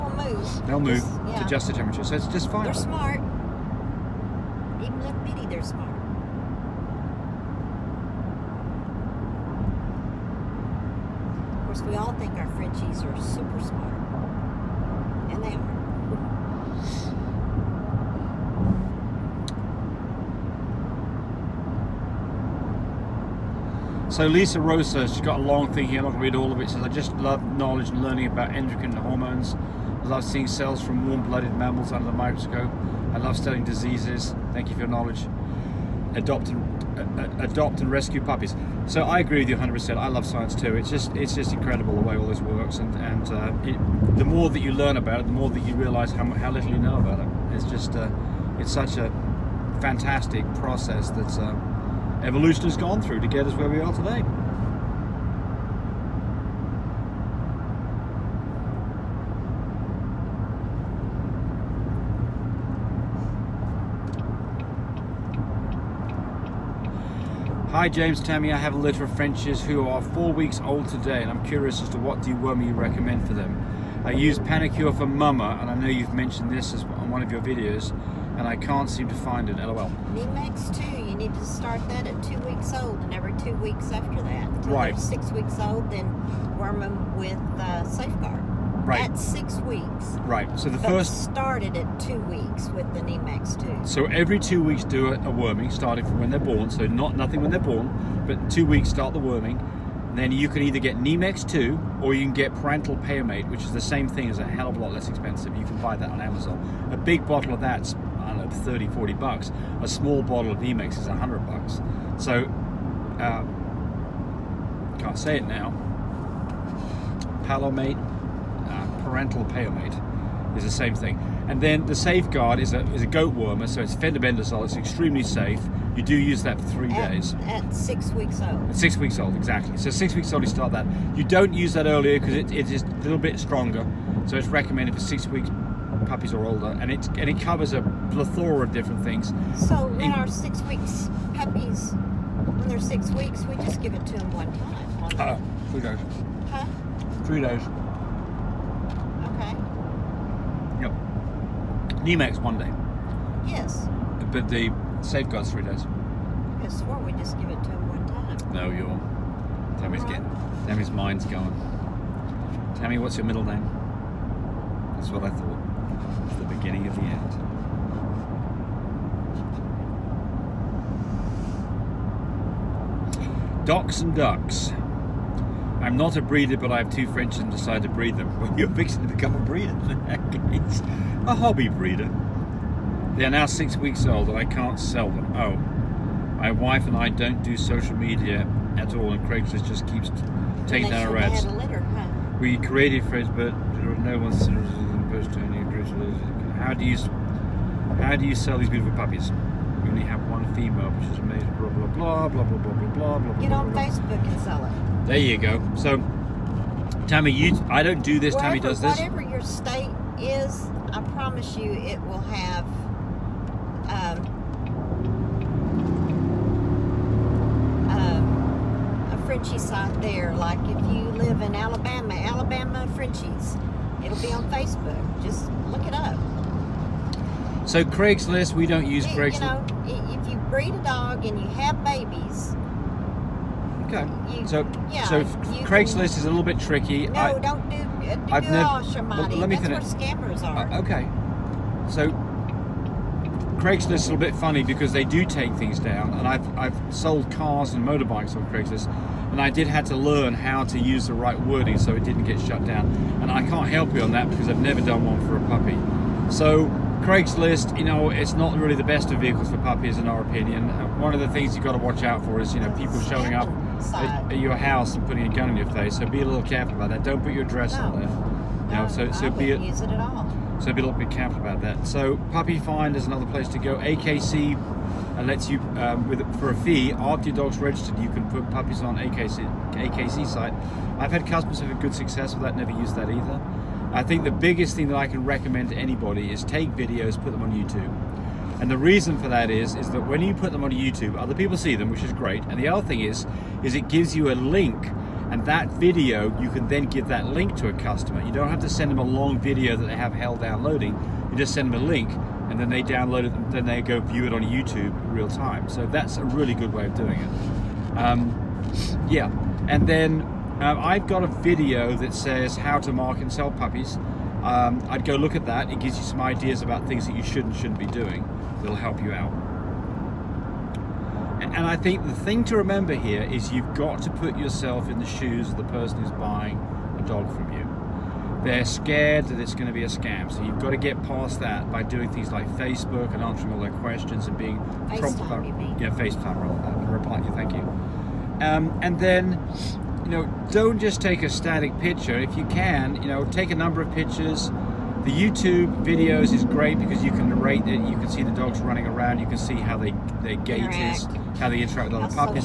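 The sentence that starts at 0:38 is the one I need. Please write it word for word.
So I agree with you 100%.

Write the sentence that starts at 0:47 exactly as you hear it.
It's just, uh, it's such a fantastic process that's...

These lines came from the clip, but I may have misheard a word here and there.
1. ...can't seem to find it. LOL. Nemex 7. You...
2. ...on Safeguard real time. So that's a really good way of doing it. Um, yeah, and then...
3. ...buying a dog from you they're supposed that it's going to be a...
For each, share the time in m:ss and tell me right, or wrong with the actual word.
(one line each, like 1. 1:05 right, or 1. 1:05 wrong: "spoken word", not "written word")
1. 1:18 wrong: "2", not "7"
2. 5:04 wrong: "YouTube", not "Safeguard"
3. 5:26 wrong: "scared", not "supposed".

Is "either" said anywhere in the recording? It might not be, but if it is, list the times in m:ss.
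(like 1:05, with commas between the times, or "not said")
1:40, 4:43.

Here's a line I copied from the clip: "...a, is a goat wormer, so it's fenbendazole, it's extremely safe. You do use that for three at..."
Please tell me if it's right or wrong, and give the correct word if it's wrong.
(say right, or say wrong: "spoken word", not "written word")
right.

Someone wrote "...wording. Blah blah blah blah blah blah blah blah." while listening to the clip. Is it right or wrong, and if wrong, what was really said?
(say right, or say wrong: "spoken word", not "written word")
wrong: "amazing", not "wording".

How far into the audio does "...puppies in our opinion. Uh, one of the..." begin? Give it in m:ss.
4:19.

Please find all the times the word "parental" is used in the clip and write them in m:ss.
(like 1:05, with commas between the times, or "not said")
1:59.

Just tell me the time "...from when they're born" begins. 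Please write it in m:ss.
1:36.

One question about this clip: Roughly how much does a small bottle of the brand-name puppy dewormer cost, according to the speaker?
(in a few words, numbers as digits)
100 bucks.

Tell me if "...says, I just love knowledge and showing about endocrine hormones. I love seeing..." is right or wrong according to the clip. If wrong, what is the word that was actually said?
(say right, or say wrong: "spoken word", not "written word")
wrong: "learning", not "showing".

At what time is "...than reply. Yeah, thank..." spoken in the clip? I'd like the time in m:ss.
5:36.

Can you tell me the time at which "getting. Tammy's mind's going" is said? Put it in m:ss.
2:40.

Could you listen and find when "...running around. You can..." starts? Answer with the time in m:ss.
5:48.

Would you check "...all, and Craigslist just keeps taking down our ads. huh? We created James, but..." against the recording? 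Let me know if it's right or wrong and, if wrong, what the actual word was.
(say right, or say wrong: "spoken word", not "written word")
wrong: "Facebook", not "James".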